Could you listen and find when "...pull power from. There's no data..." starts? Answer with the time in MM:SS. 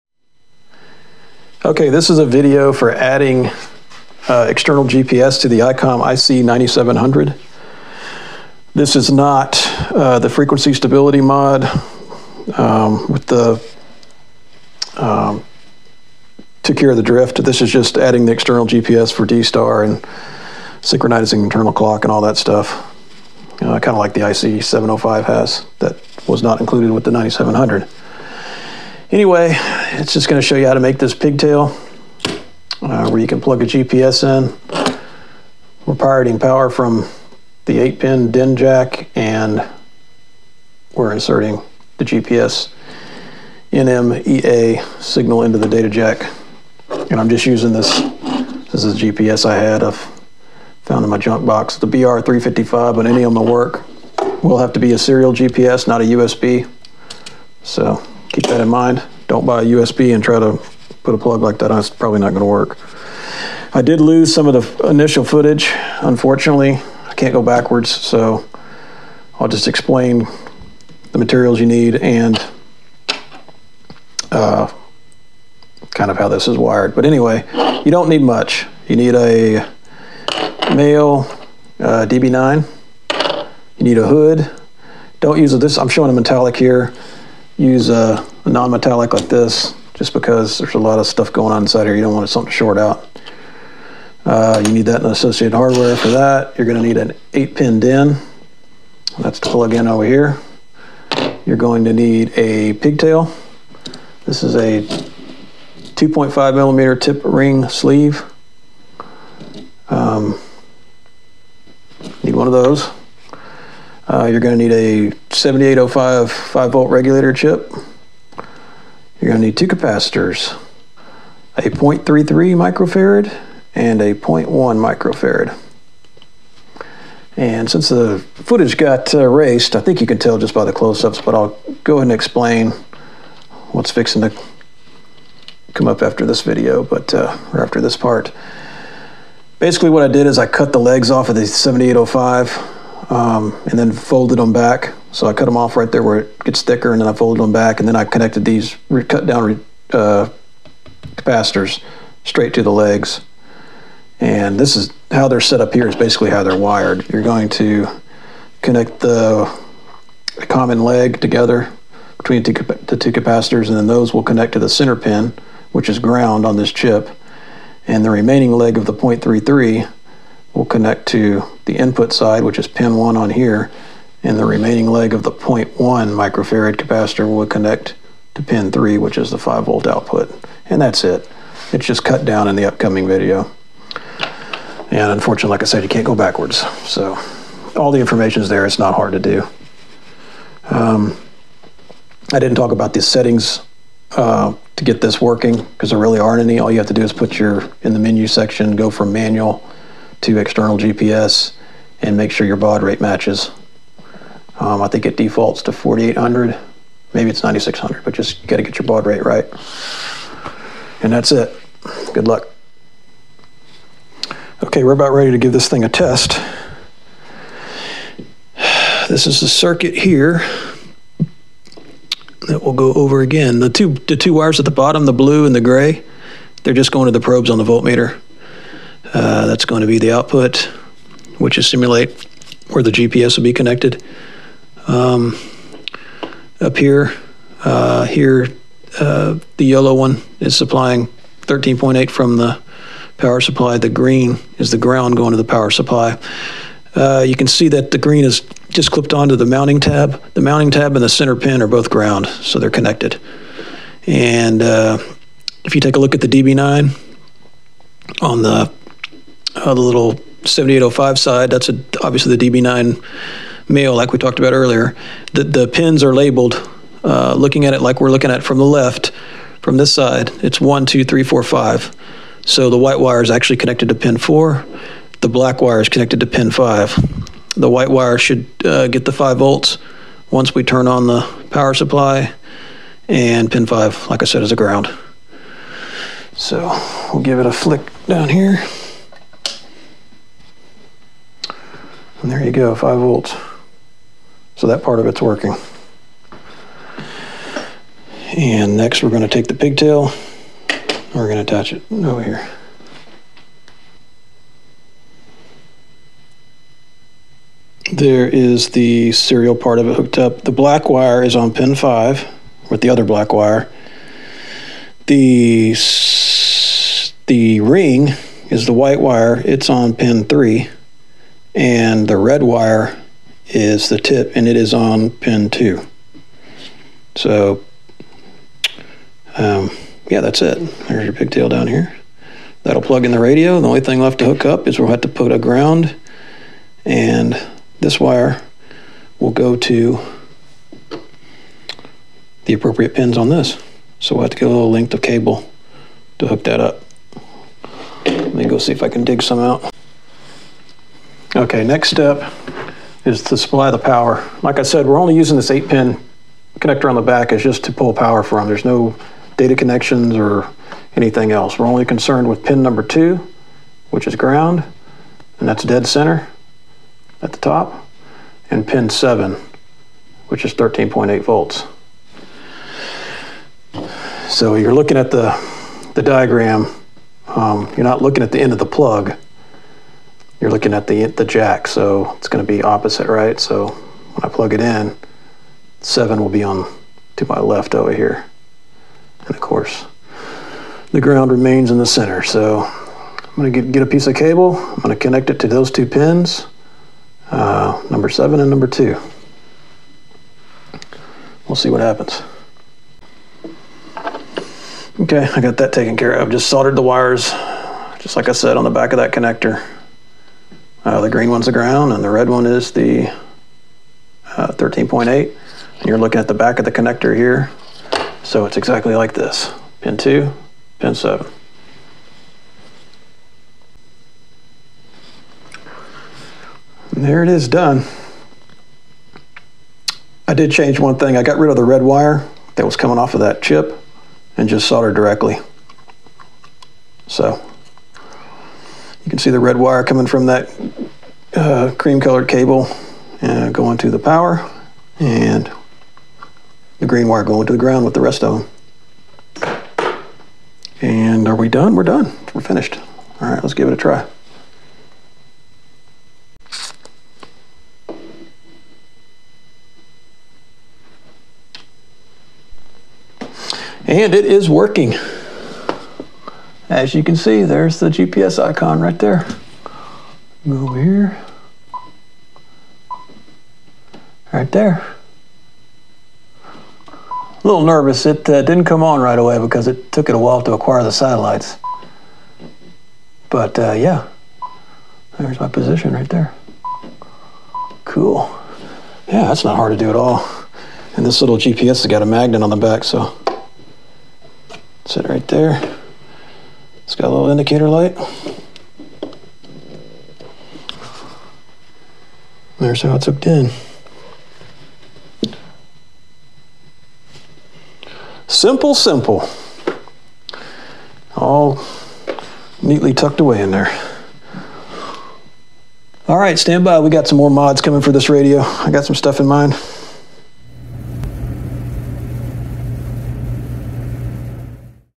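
05:57.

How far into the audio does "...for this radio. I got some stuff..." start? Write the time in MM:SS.
08:37.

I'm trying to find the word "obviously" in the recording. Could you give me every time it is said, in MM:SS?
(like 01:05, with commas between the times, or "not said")
04:22.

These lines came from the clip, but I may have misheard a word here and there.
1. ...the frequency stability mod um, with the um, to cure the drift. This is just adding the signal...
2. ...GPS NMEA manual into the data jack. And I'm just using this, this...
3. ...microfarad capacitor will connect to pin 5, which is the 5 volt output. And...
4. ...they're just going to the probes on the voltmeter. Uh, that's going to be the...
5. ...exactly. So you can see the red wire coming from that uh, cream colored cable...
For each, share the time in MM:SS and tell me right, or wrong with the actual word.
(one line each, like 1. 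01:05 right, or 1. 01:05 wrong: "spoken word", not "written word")
1. 00:10 wrong: "external", not "signal"
2. 00:42 wrong: "signal", not "manual"
3. 02:55 wrong: "3", not "5"
4. 03:46 right
5. 07:14 wrong: "directly", not "exactly".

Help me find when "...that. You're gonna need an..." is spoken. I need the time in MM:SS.
01:36.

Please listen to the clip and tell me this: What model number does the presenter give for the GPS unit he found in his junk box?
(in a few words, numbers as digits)
BR355.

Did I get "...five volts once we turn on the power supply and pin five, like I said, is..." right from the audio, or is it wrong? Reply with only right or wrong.
right.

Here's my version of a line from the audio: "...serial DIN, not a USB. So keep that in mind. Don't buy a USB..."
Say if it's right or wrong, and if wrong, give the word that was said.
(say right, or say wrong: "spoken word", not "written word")
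wrong: "GPS", not "DIN".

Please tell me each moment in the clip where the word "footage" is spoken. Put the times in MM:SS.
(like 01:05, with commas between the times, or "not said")
01:05, 02:08.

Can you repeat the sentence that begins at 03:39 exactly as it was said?
This is the circuit here that we'll go over again.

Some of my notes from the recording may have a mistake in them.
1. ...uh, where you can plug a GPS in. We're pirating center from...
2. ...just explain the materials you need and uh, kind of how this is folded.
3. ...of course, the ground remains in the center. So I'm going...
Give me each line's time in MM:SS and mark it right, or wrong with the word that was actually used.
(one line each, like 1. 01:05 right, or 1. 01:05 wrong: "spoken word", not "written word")
1. 00:32 wrong: "power", not "center"
2. 01:09 wrong: "wired", not "folded"
3. 06:29 right.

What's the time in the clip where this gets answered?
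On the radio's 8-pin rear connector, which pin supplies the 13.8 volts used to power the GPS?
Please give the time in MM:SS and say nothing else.
06:08.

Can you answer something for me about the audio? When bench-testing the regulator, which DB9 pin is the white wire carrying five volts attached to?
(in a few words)
pin four.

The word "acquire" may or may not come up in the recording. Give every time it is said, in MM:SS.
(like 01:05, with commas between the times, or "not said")
08:00.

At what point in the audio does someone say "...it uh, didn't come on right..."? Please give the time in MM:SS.
07:58.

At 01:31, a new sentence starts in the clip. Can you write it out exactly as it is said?
You don't want something to short out.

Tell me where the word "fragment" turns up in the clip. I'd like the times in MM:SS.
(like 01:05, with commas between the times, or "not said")
not said.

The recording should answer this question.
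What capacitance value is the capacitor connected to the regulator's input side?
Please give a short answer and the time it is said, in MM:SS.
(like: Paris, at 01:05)
0.33 microfarad, at 02:01.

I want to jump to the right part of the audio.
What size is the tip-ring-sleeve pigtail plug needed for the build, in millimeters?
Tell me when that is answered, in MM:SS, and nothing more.
01:45.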